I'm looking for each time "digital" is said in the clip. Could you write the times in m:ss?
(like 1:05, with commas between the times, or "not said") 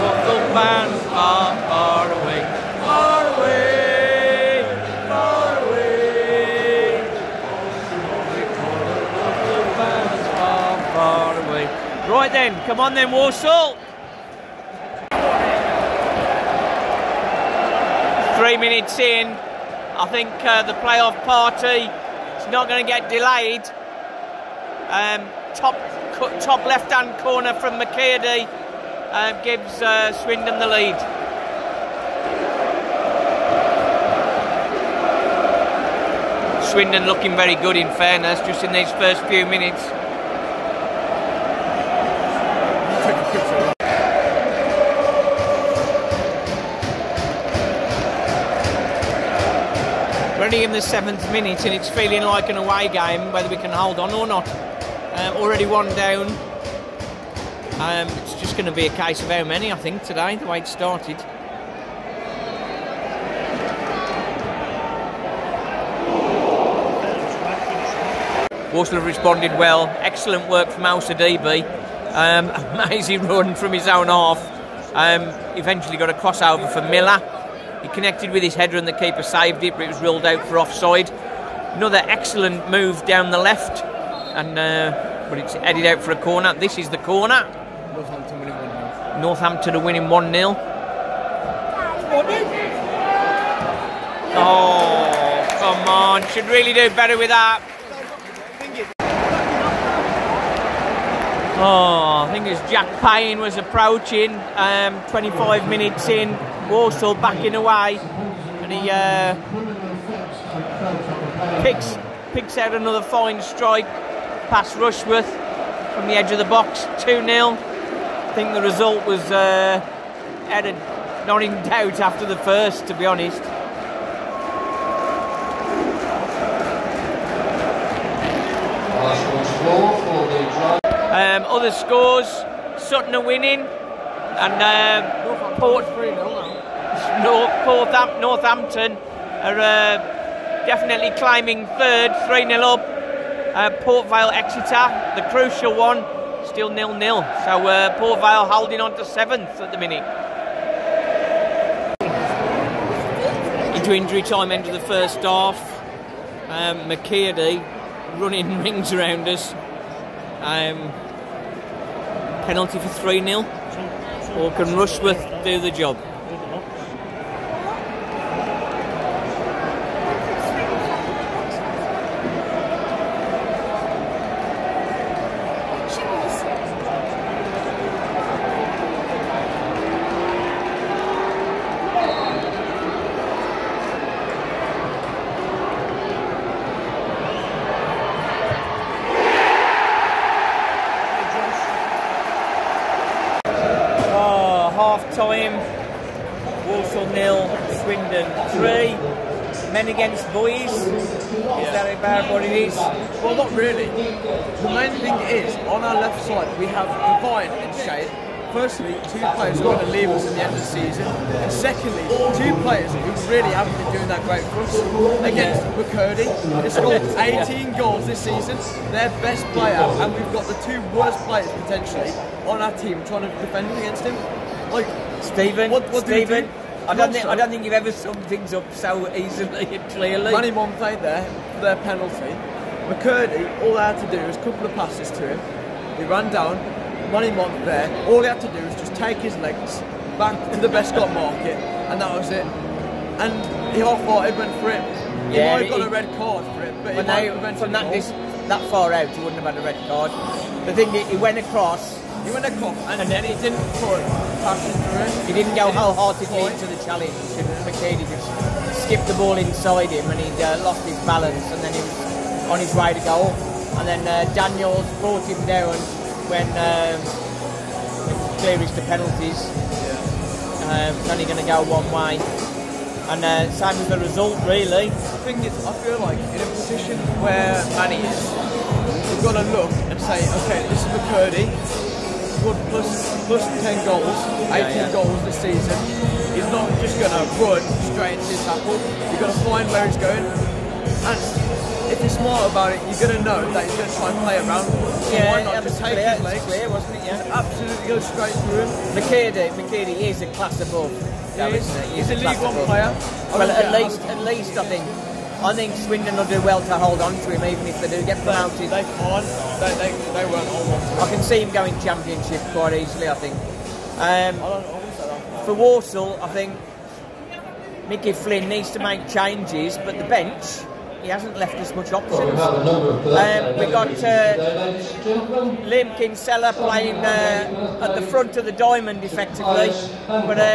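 not said.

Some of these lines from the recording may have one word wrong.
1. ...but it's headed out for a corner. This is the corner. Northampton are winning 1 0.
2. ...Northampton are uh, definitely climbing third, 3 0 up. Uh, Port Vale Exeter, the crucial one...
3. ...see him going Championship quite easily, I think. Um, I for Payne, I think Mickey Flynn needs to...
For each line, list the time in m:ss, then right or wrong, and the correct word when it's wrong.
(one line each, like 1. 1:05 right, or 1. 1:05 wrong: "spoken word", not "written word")
1. 1:25 right
2. 2:18 right
3. 5:11 wrong: "Walsall", not "Payne".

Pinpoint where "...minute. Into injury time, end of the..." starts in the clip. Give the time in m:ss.
2:29.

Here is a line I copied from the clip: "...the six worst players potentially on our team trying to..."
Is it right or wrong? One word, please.
wrong.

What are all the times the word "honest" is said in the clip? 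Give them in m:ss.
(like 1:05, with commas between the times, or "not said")
2:03.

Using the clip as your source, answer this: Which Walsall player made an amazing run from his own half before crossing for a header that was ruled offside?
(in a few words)
Osadebe.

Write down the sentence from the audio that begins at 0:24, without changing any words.
Um, top top left-hand corner from McKirdy uh, gives uh, Swindon the lead.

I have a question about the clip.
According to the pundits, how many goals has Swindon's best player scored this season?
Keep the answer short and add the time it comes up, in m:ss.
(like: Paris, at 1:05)
18, at 3:37.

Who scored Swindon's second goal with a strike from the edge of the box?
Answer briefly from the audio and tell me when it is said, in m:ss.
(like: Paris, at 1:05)
Jack Payne, at 1:42.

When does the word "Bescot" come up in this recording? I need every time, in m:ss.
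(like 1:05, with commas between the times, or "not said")
4:00.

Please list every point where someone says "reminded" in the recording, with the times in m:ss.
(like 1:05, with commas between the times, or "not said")
not said.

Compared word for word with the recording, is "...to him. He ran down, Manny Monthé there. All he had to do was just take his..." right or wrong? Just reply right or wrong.
right.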